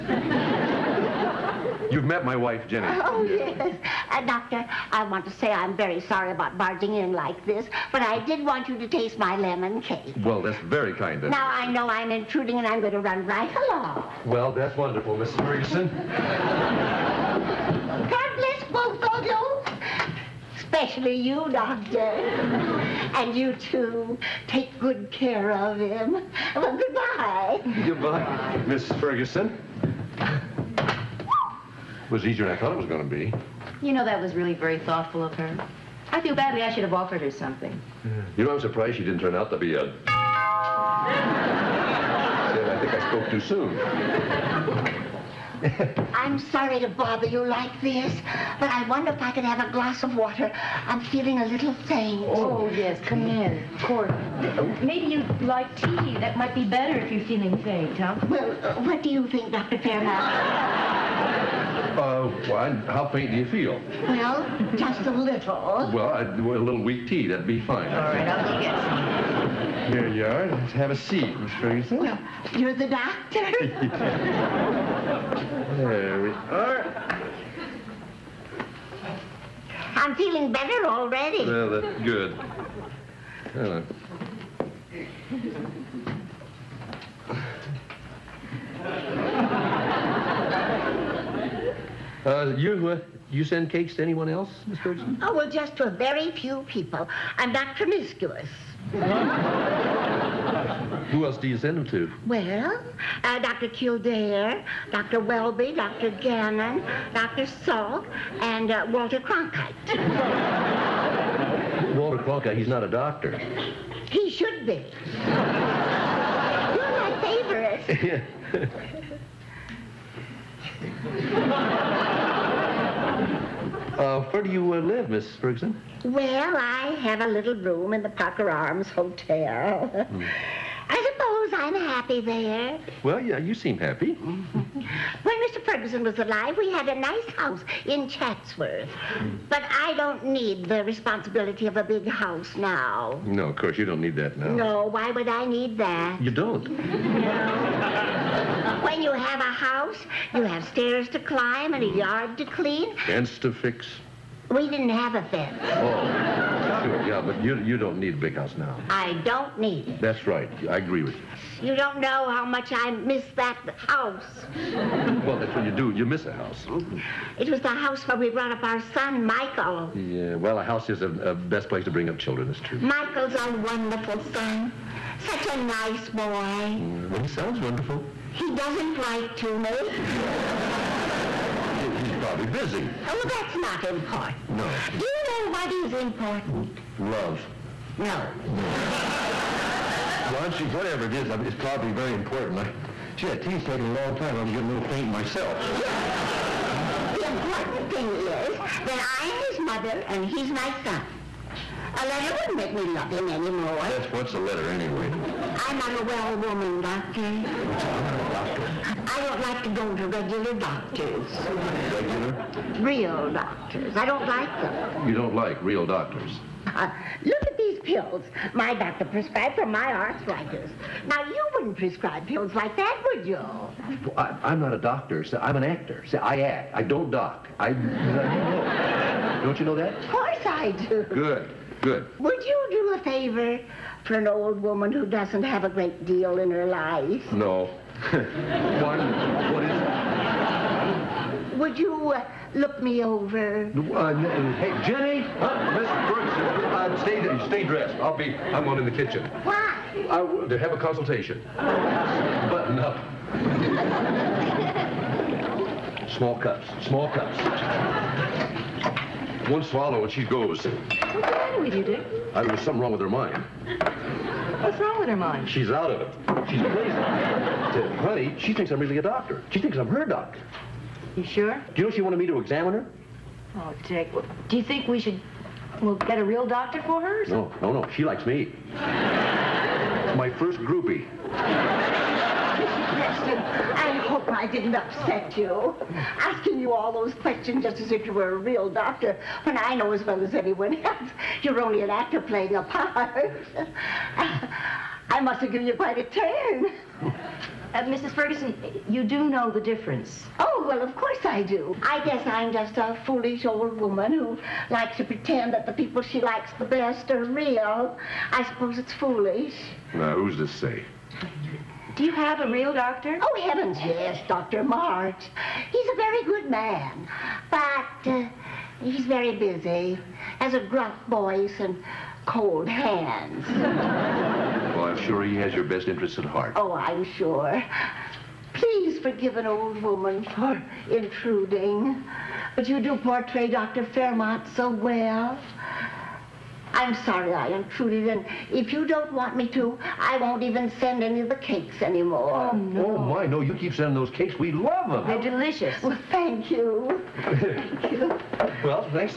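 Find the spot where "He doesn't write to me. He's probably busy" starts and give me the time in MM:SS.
02:58.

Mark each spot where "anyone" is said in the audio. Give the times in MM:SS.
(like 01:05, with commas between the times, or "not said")
01:34, 04:50.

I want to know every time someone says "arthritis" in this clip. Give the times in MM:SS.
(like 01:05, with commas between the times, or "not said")
03:39.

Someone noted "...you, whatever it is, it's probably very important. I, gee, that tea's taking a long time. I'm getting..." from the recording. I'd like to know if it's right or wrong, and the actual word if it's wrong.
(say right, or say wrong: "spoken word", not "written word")
right.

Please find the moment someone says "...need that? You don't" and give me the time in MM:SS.
02:25.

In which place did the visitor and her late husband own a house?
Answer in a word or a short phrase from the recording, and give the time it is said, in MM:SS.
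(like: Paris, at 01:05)
Chatsworth, at 02:18.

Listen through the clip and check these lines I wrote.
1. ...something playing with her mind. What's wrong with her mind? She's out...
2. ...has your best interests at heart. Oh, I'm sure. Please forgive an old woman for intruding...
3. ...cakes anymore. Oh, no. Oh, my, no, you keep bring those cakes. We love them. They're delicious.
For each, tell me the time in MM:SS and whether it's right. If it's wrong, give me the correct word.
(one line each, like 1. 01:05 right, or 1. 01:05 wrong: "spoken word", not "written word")
1. 04:22 wrong: "wrong", not "playing"
2. 05:25 right
3. 05:41 wrong: "sending", not "bring".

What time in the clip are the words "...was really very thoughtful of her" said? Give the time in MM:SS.
00:34.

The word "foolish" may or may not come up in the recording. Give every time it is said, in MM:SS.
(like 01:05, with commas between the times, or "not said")
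05:03, 05:08.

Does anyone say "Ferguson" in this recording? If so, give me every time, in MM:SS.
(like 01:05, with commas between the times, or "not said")
00:15, 00:28, 01:11, 01:34, 02:05, 02:15, 04:58.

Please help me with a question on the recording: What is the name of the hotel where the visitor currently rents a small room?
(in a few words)
Parker Arms Hotel.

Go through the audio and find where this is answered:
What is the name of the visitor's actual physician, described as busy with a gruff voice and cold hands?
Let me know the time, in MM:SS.
05:14.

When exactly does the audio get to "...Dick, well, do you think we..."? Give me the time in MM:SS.
04:33.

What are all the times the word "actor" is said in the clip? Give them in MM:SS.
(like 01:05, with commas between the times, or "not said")
03:45, 04:51.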